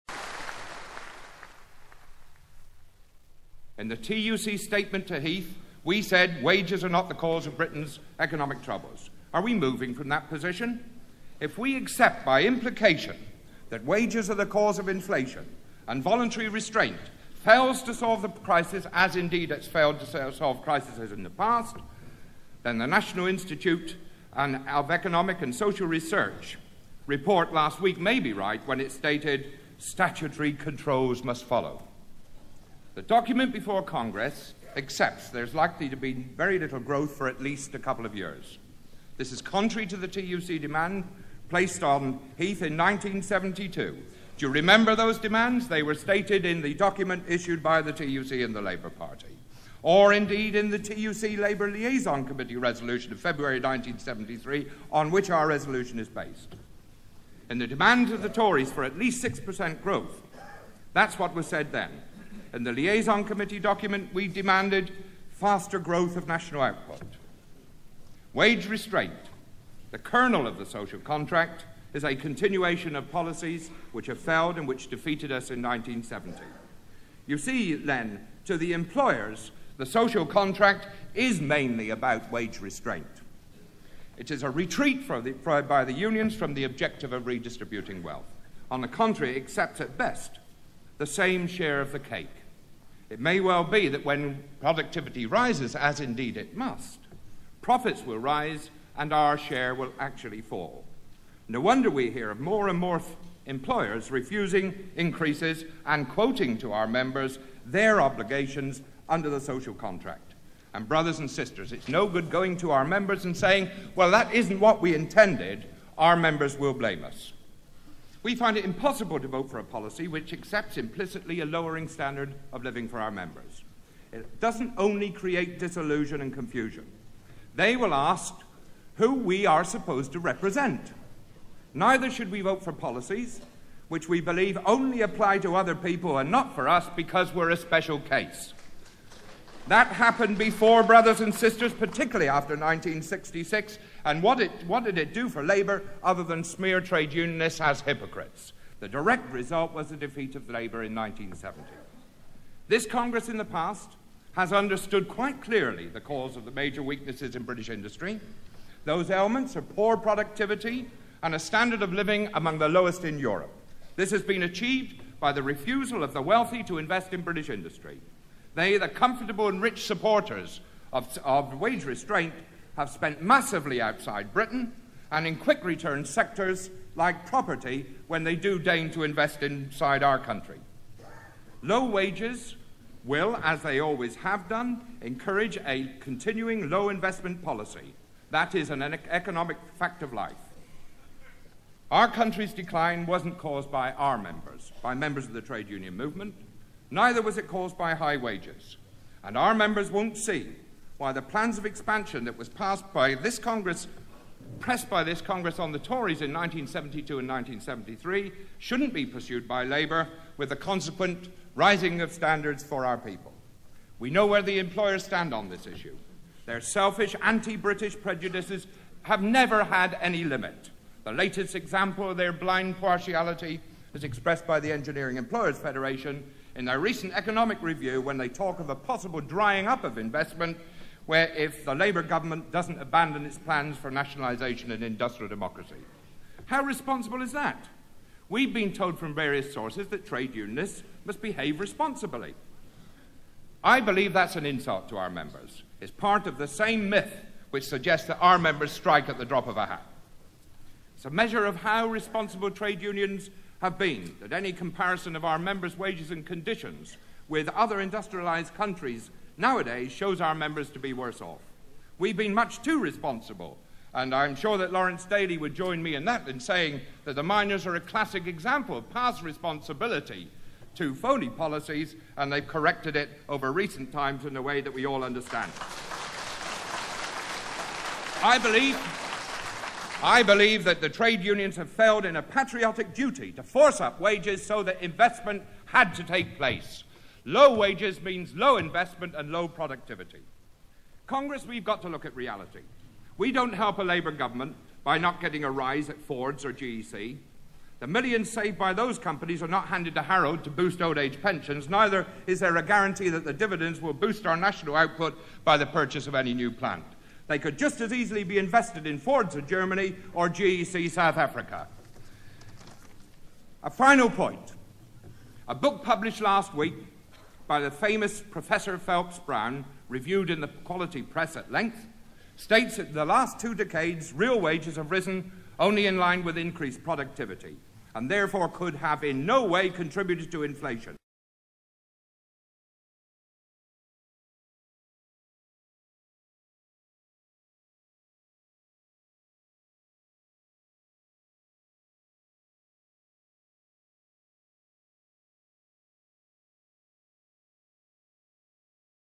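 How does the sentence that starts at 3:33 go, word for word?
We know where the employers stand on this issue.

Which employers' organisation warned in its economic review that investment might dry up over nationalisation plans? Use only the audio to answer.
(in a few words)
Engineering Employers Federation.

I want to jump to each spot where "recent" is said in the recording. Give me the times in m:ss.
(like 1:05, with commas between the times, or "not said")
3:46, 4:33.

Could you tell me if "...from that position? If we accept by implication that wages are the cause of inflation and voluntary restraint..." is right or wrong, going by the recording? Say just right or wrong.
right.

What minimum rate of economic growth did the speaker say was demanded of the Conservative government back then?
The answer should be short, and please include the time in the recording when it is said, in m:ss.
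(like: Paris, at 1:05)
6%, at 0:59.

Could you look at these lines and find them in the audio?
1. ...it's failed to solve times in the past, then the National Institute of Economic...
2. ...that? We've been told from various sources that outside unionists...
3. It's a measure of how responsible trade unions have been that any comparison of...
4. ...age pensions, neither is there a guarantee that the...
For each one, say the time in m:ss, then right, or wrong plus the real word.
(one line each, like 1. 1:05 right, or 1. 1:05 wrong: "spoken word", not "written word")
1. 0:19 wrong: "crises", not "times"
2. 3:57 wrong: "trade", not "outside"
3. 4:10 right
4. 5:00 right.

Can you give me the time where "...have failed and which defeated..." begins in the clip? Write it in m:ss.
1:14.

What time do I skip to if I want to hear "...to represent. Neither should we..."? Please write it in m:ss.
2:10.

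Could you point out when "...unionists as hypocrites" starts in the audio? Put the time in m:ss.
2:27.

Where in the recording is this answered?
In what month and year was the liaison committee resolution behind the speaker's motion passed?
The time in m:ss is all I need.
0:53.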